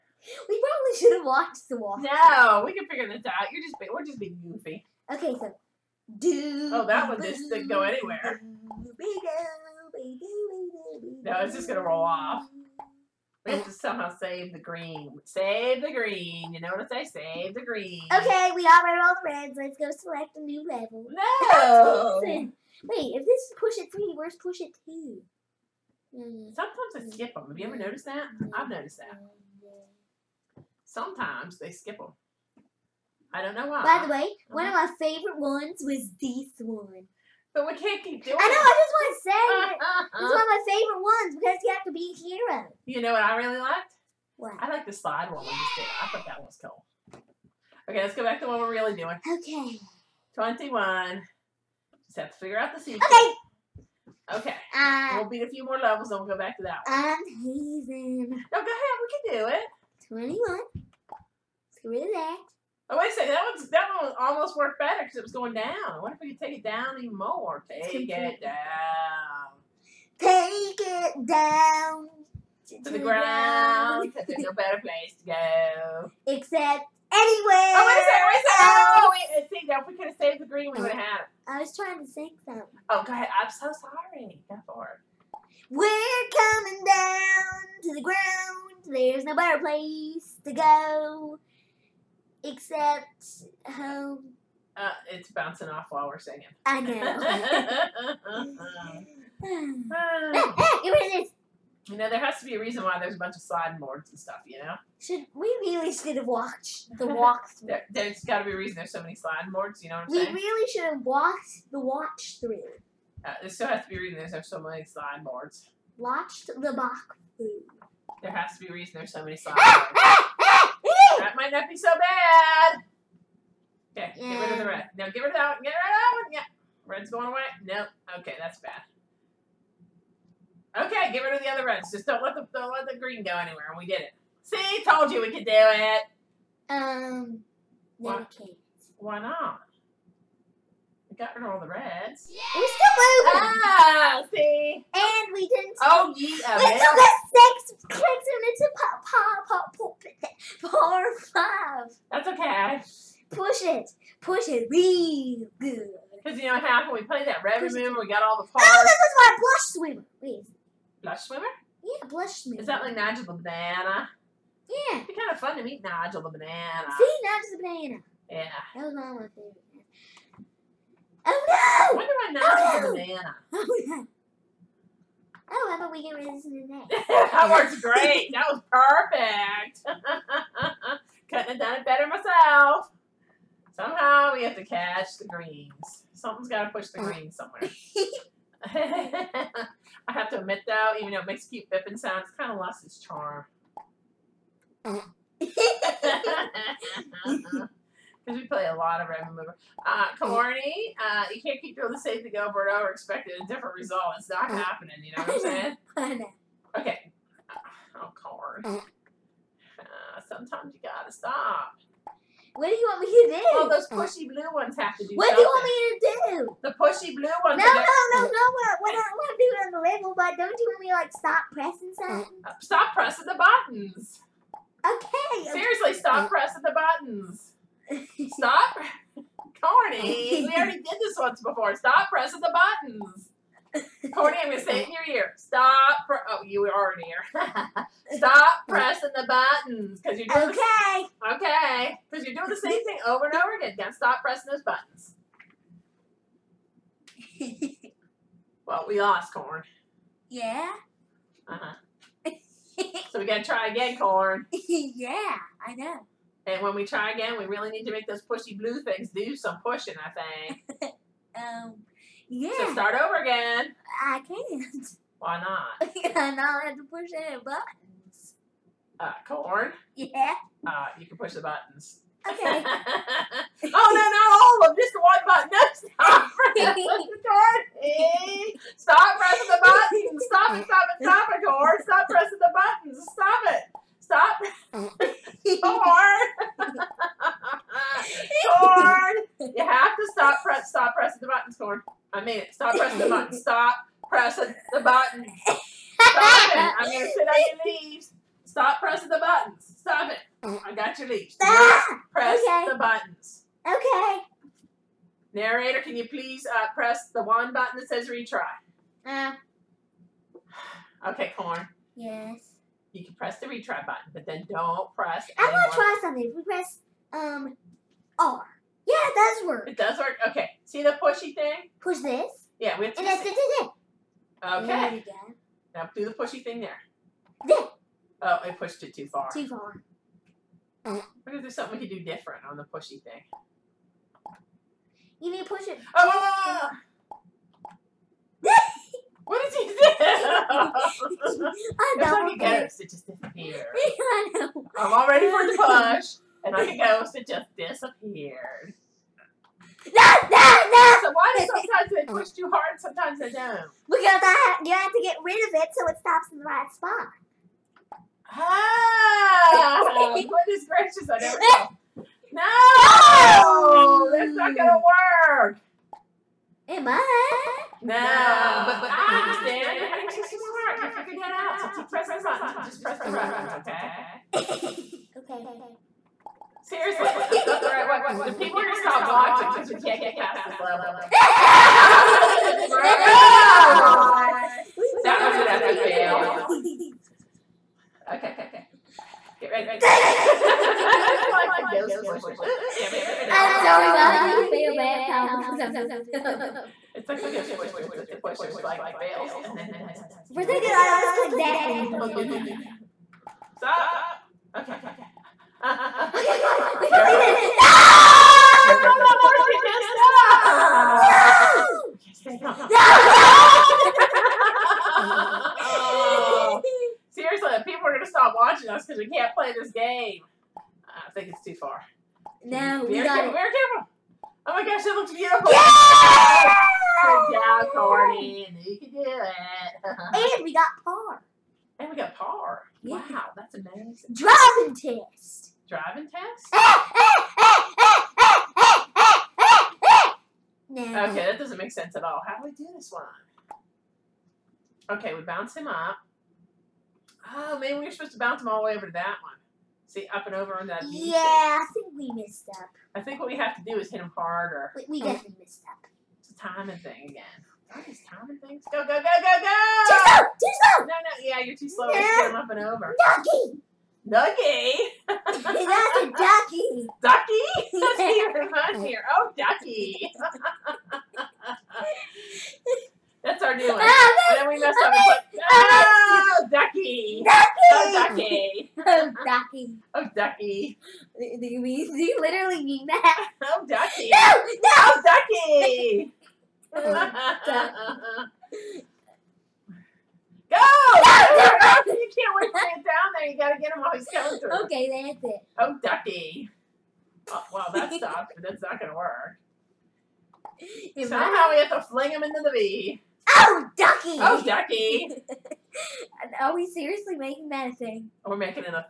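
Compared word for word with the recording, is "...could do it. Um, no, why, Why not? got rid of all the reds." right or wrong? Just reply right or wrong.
right.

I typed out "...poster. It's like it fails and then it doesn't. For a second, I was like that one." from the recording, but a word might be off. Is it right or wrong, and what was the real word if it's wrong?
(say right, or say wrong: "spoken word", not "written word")
right.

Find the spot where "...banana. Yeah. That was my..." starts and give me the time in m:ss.
2:47.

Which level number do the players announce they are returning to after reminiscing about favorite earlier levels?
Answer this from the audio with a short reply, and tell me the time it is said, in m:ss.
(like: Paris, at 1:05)
21, at 0:50.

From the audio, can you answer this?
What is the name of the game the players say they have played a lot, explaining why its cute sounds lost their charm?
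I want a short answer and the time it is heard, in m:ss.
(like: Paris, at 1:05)
Red Remover, at 3:19.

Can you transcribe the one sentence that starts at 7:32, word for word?
I think what we have to do is hit him harder.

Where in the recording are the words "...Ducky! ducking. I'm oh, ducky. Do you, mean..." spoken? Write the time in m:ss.
7:56.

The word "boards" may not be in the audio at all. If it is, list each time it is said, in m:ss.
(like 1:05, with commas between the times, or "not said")
1:43, 1:49, 1:55.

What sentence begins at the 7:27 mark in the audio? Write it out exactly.
Oh, man, we are supposed to bounce him all the way over to that one.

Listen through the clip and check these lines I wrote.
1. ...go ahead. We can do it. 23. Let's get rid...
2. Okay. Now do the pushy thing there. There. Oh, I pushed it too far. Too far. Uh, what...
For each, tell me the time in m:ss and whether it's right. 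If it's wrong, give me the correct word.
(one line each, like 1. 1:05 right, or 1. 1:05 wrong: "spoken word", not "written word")
1. 0:58 wrong: "21", not "23"
2. 5:24 right.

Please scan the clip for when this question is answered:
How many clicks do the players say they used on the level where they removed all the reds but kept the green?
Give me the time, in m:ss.
2:27.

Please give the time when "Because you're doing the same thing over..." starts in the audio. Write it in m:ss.
4:02.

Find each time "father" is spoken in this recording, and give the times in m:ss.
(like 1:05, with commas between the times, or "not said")
not said.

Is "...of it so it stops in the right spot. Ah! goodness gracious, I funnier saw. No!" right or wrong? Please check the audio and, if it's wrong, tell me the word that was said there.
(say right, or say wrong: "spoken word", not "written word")
wrong: "never", not "funnier".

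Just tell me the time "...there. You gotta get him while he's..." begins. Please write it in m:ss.
8:13.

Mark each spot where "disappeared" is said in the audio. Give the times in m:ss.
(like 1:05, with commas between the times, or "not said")
5:43, 5:47.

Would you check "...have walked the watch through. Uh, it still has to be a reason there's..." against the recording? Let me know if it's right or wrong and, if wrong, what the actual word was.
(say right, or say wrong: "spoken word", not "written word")
right.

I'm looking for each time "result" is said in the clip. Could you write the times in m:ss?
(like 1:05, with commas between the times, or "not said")
3:23.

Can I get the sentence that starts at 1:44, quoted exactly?
Should we really should have watched the walkthrough.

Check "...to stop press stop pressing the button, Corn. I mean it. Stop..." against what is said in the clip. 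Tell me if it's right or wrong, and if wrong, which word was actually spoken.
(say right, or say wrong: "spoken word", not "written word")
right.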